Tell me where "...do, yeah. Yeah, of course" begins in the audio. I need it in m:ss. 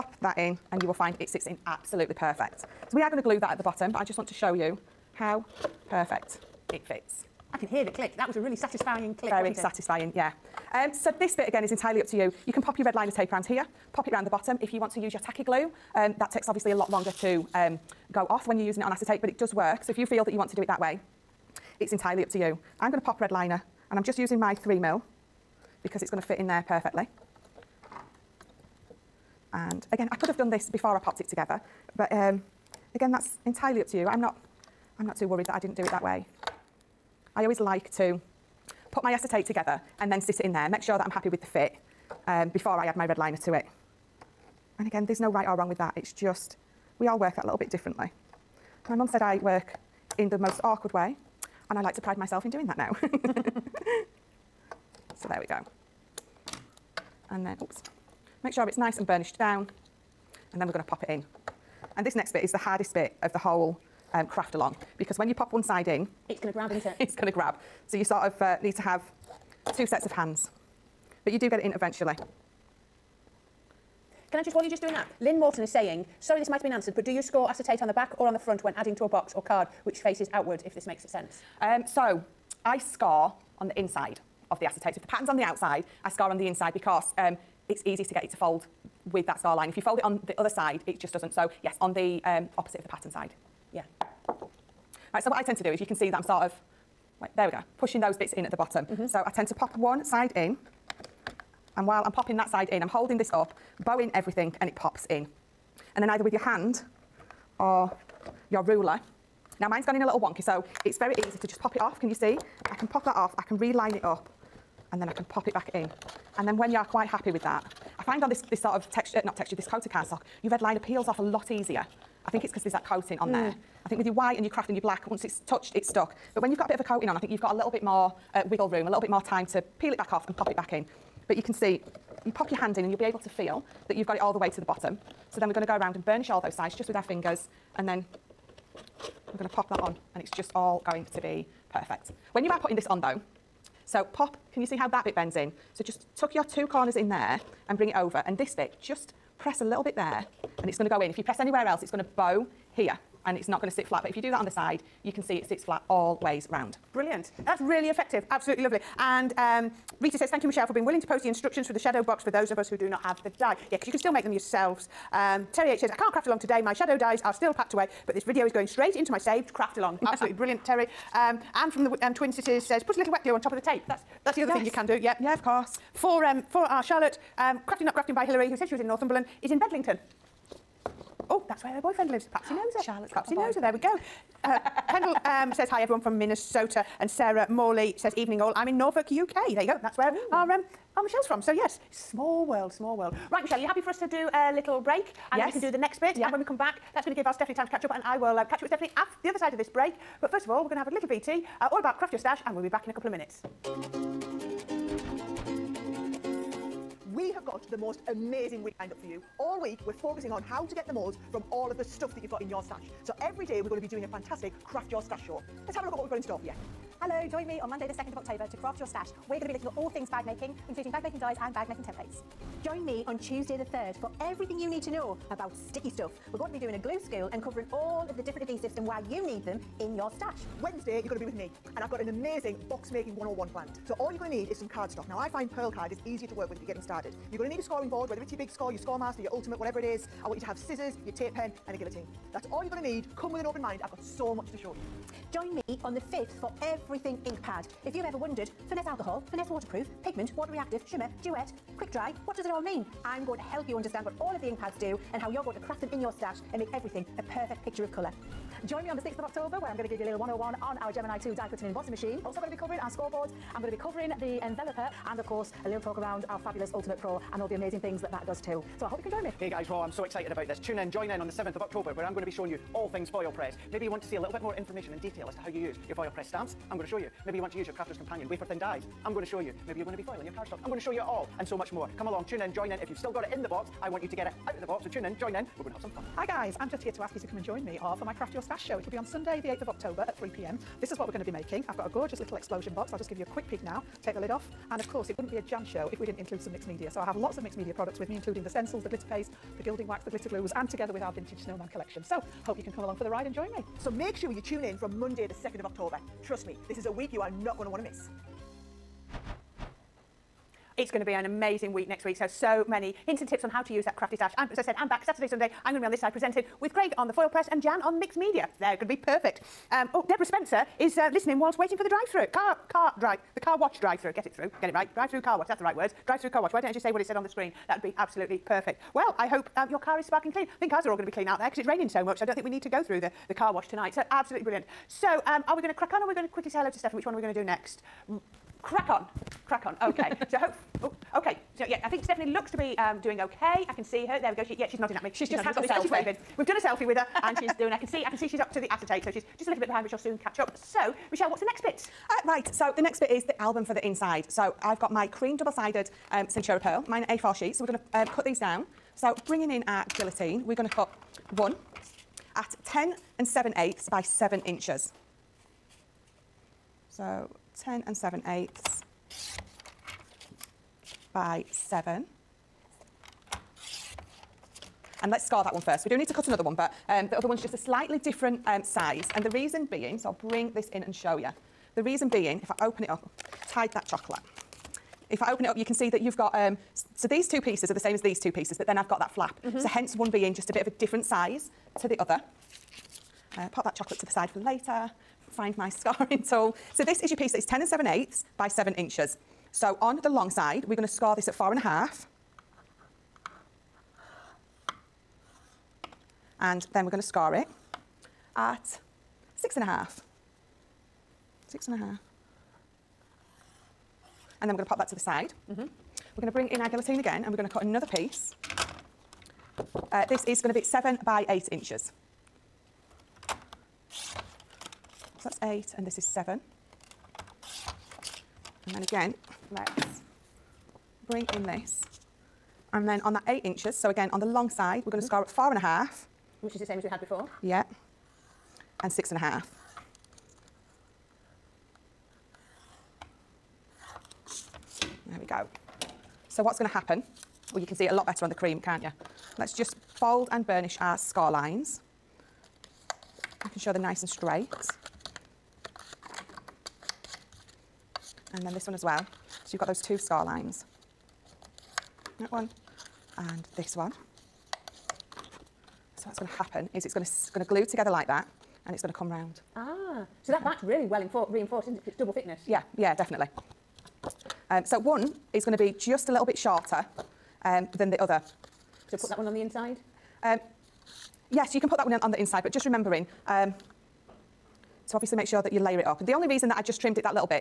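2:54.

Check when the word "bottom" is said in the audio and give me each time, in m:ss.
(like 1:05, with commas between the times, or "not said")
0:03, 0:14, 1:38, 2:14.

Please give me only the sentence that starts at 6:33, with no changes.
Uh, pop that chocolate to the side for later.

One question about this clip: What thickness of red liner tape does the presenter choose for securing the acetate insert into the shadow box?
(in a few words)
3 mil.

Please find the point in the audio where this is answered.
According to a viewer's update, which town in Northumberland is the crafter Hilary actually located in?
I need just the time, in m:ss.
2:59.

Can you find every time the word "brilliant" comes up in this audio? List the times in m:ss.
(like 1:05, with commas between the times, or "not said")
2:36, 2:50, 5:34.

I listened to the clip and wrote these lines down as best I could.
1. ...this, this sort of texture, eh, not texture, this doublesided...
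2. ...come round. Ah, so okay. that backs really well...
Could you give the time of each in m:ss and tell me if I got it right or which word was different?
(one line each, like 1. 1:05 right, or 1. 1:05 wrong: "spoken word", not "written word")
1. 1:58 wrong: "coated", not "doublesided"
2. 7:48 right.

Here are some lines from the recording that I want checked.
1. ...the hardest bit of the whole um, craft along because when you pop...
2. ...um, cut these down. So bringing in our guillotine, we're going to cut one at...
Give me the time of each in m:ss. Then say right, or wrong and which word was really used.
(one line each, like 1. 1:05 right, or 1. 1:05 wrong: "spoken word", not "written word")
1. 1:02 right
2. 5:57 right.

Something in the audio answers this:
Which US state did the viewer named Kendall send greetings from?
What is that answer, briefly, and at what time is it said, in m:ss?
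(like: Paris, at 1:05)
Minnesota, at 3:06.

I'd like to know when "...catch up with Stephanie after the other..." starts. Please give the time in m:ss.
3:18.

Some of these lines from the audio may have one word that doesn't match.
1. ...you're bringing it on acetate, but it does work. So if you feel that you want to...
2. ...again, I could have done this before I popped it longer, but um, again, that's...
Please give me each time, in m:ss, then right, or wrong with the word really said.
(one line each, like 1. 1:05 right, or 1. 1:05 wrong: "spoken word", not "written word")
1. 0:18 wrong: "using", not "bringing"
2. 0:29 wrong: "together", not "longer".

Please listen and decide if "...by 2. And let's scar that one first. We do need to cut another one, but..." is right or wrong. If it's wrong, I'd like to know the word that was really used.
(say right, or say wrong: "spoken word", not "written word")
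wrong: "7", not "2".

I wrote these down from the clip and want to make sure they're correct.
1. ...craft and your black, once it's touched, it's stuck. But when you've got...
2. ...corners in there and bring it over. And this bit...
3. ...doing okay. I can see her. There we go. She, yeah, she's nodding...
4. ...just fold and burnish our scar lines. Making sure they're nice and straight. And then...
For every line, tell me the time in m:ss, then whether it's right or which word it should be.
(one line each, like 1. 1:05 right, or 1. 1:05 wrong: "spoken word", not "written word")
1. 2:04 right
2. 2:26 right
3. 5:43 right
4. 7:29 right.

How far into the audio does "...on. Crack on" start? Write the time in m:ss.
5:38.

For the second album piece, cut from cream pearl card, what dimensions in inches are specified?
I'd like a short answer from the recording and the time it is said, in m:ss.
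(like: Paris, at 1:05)
7 by 8 inches, at 7:00.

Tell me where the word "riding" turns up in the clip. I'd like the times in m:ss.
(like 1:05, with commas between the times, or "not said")
not said.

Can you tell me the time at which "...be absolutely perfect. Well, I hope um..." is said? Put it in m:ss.
5:27.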